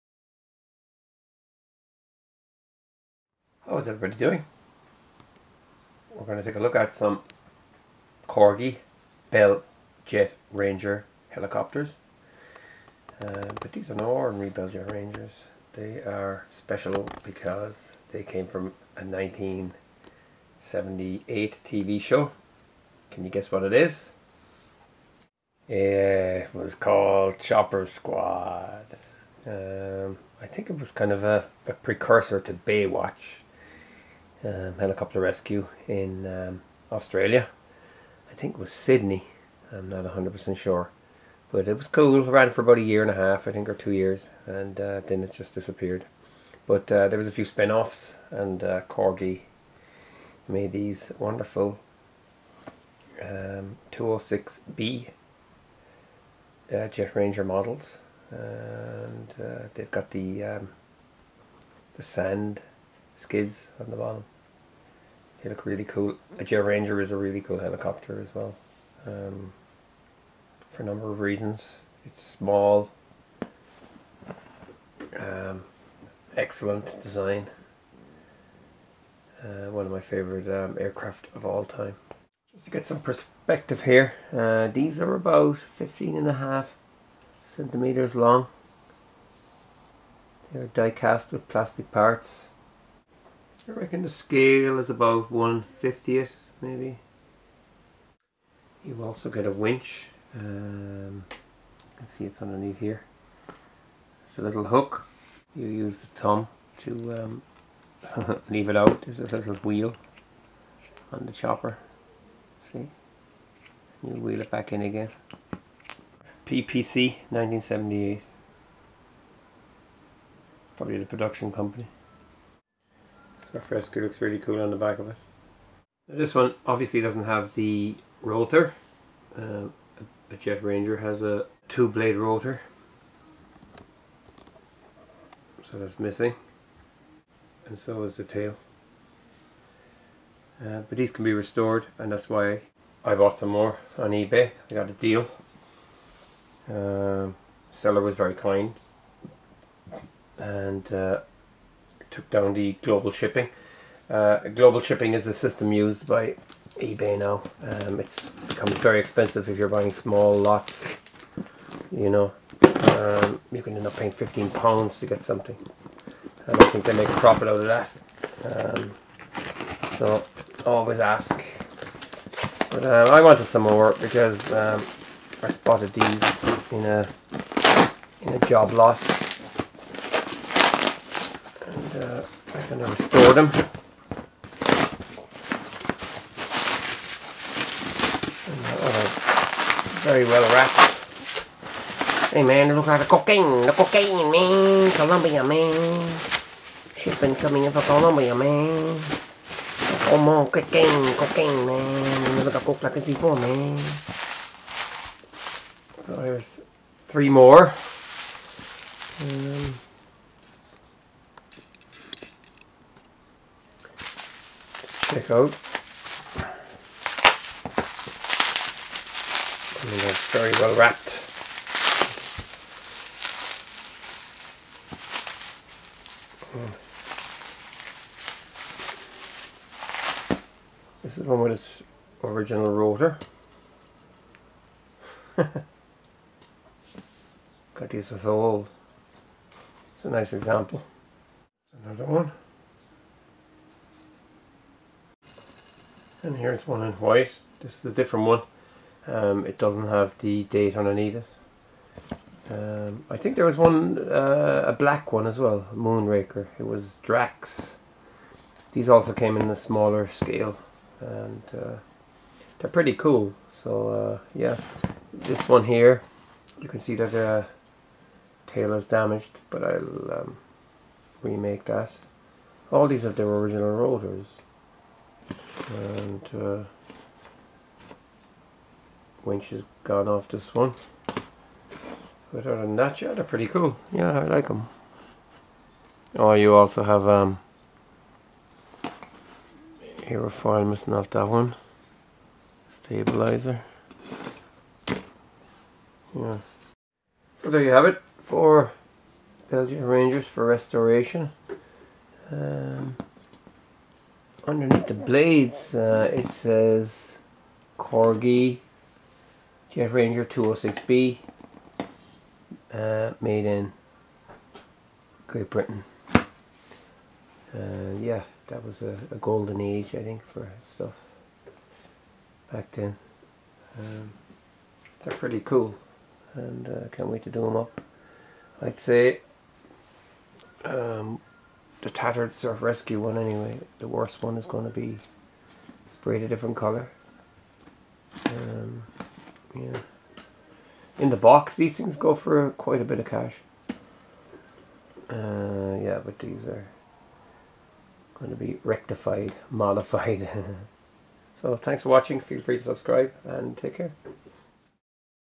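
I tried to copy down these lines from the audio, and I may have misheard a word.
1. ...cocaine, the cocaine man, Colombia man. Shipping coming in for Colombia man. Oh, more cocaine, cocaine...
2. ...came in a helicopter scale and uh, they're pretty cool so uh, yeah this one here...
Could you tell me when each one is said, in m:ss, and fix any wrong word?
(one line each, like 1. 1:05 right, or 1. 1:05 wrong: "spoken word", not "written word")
1. 3:13 right
2. 4:19 wrong: "smaller", not "helicopter".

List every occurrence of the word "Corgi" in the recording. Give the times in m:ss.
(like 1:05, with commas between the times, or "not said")
0:08, 0:48, 5:07.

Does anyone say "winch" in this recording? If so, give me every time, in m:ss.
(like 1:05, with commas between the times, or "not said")
1:39, 4:39.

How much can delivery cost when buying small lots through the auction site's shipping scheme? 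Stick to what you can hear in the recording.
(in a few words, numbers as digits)
15 pounds.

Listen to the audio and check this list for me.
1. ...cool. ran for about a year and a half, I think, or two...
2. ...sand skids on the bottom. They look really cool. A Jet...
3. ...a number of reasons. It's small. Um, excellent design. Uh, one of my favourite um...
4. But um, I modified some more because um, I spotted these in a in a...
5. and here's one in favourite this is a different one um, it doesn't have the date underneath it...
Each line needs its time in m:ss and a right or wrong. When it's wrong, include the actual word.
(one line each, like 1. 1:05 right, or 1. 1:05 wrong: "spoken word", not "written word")
1. 0:41 right
2. 1:02 right
3. 1:10 right
4. 2:52 wrong: "wanted", not "modified"
5. 4:06 wrong: "white", not "favourite".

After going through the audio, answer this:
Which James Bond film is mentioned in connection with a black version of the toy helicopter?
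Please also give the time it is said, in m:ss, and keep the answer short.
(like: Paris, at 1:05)
Moonraker, at 4:15.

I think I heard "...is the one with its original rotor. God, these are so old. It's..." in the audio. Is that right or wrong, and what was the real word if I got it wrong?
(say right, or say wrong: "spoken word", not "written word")
right.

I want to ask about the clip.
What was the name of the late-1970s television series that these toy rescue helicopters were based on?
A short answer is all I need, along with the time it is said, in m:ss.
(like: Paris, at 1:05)
Chopper Squad, at 0:27.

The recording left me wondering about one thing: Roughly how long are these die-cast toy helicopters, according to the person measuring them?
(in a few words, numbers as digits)
15.5 centimetres.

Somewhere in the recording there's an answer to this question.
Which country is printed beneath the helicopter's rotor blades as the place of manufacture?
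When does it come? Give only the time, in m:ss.
5:15.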